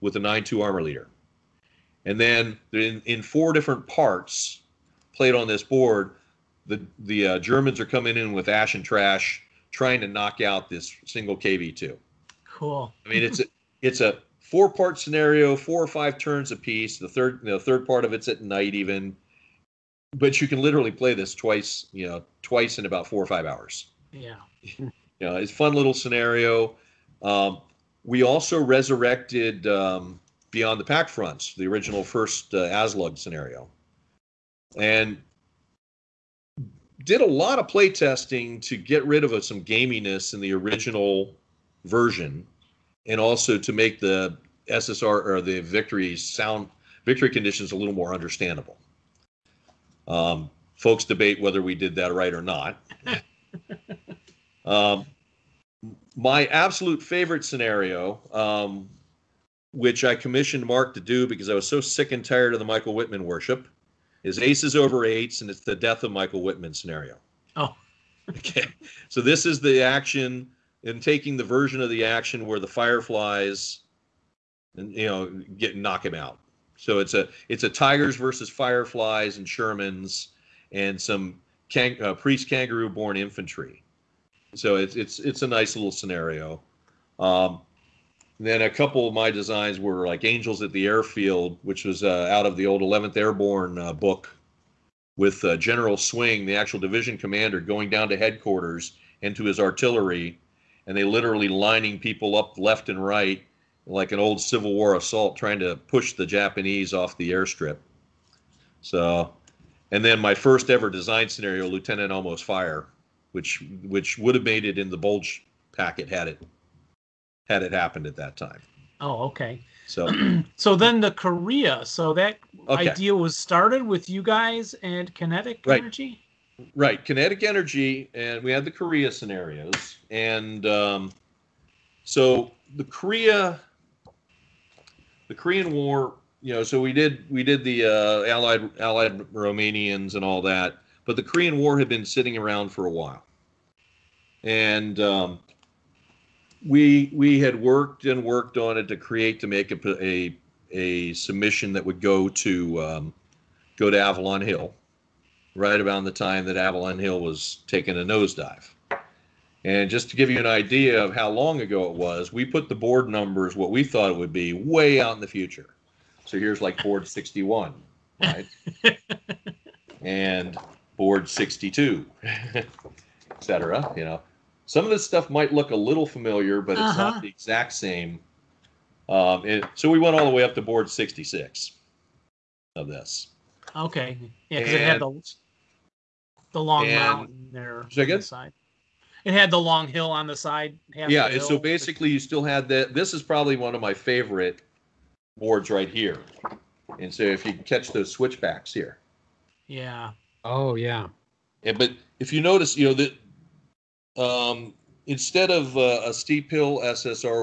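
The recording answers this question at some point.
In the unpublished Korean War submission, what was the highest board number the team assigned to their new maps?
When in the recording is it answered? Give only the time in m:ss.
3:00.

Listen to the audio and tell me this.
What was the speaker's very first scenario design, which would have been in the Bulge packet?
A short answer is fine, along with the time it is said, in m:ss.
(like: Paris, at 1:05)
Lieutenant Almost Fire, at 1:51.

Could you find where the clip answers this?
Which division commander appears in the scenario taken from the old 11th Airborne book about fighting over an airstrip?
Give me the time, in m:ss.
1:35.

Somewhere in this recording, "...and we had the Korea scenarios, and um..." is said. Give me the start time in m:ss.
2:08.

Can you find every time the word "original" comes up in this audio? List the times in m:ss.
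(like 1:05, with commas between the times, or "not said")
0:31, 0:40.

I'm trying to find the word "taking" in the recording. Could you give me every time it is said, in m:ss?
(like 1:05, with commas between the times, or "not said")
1:11, 2:37.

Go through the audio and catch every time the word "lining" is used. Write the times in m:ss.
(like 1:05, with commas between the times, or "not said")
1:41.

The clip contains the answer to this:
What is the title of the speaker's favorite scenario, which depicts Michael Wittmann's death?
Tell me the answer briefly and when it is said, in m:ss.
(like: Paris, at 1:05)
Aces Over Eights, at 1:04.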